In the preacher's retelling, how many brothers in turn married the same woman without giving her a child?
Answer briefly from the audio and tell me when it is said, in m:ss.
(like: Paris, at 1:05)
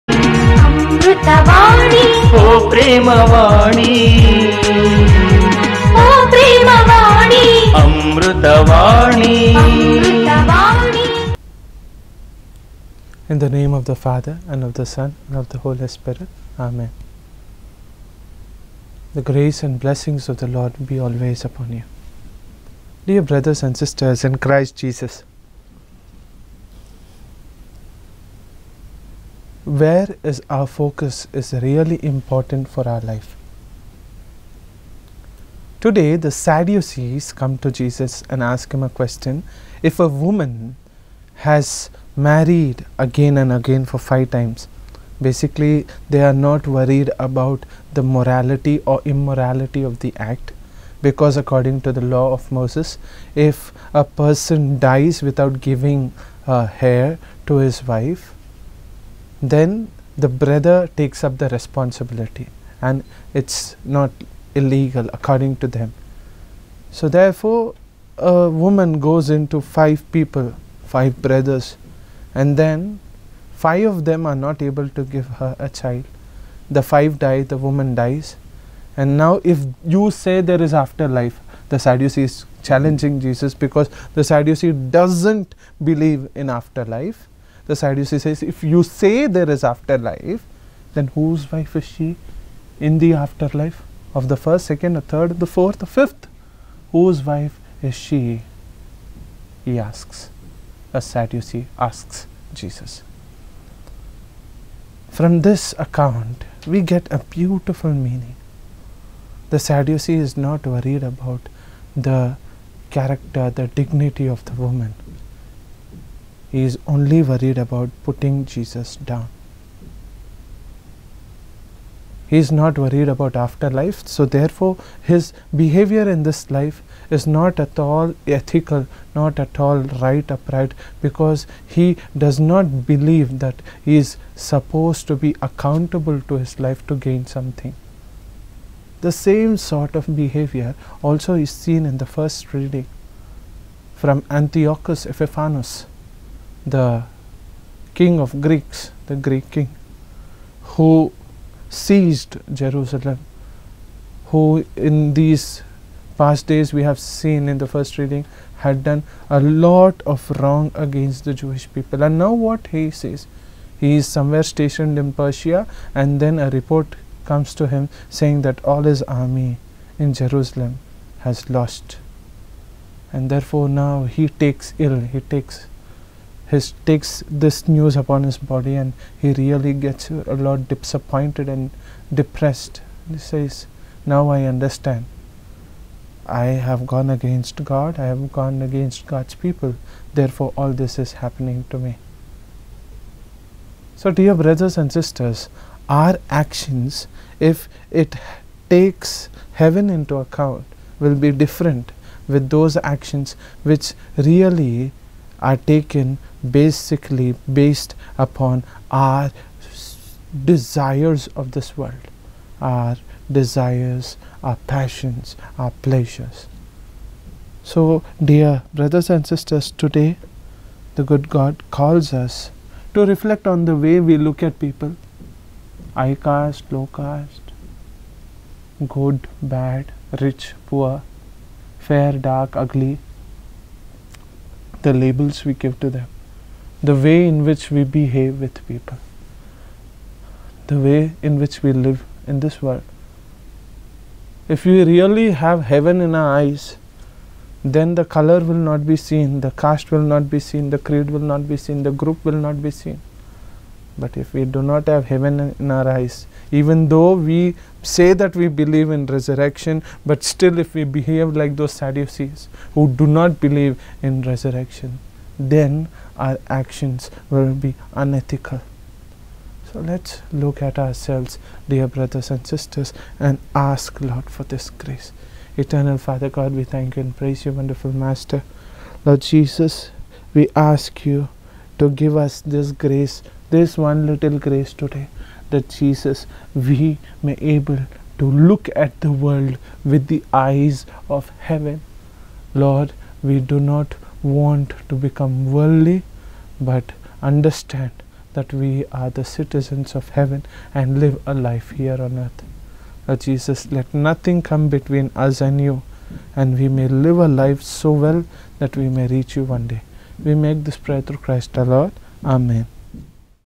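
5, at 1:10.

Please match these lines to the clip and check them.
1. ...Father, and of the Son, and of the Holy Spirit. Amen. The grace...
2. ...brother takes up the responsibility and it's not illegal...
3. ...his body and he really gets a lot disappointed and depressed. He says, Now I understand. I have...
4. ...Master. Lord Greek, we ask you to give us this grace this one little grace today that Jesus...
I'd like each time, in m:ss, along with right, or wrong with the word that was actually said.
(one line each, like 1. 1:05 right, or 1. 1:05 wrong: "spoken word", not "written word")
1. 0:14 right
2. 1:00 right
3. 2:58 right
4. 4:37 wrong: "Jesus", not "Greek".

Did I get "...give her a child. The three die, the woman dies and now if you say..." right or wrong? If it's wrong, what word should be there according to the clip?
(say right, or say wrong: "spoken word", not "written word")
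wrong: "five", not "three".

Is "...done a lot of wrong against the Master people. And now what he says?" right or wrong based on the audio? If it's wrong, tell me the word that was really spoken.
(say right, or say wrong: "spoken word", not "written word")
wrong: "Jewish", not "Master".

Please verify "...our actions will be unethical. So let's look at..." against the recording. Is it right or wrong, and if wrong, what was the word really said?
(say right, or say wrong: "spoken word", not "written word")
right.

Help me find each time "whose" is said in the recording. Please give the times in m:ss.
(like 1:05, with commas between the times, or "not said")
1:31, 1:36.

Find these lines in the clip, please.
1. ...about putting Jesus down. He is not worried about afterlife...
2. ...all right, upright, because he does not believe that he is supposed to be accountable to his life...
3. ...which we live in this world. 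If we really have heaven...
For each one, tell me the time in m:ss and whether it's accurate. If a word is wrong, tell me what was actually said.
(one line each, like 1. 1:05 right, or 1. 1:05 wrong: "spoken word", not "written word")
1. 1:57 right
2. 2:09 right
3. 4:01 right.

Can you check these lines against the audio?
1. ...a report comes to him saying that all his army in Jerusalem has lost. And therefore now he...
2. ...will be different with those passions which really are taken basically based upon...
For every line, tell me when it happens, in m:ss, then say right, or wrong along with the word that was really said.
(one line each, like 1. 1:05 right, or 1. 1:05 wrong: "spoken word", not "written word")
1. 2:46 right
2. 3:20 wrong: "actions", not "passions".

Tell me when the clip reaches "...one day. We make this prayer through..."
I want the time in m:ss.
5:09.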